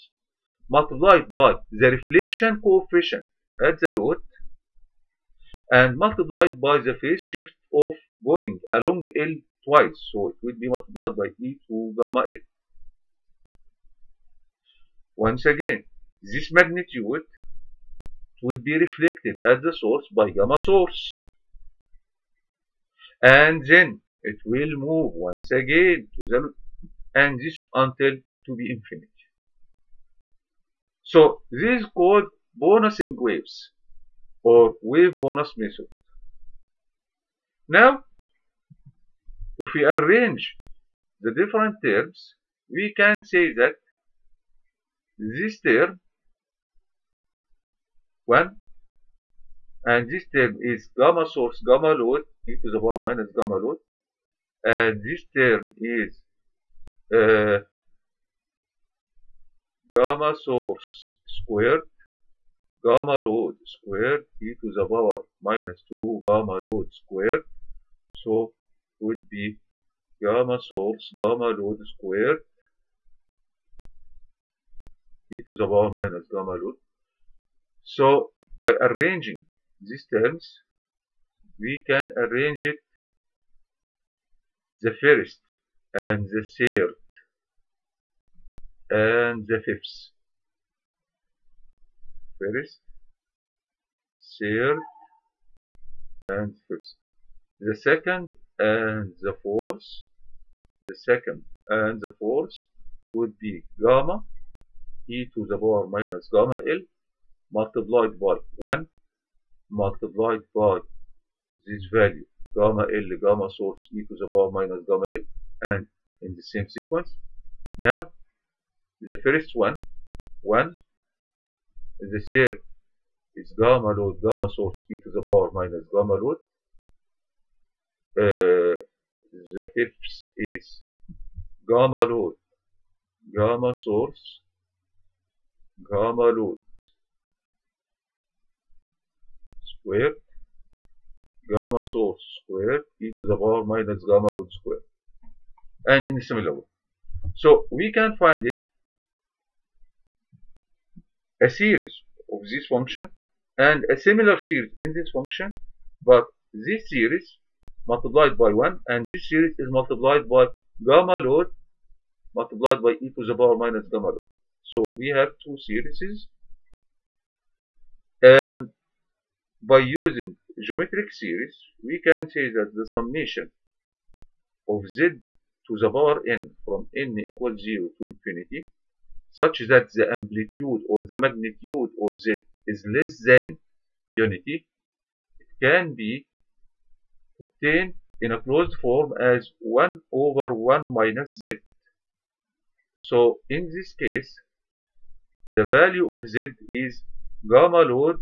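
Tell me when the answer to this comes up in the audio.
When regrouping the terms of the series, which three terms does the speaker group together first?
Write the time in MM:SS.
01:24.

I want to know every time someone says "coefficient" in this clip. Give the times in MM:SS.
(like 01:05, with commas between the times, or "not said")
00:02.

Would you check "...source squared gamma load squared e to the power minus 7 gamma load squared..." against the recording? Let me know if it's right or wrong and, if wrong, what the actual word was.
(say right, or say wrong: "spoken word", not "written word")
wrong: "2", not "7".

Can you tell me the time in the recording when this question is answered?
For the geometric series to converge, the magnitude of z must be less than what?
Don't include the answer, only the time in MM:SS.
03:04.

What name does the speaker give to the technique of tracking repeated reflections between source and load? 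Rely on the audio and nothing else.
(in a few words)
Bouncing waves.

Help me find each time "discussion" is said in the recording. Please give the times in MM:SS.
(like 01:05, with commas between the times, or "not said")
not said.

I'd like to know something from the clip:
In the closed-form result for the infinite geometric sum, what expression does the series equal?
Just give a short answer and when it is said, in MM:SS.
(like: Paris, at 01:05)
1 over 1 minus z, at 03:09.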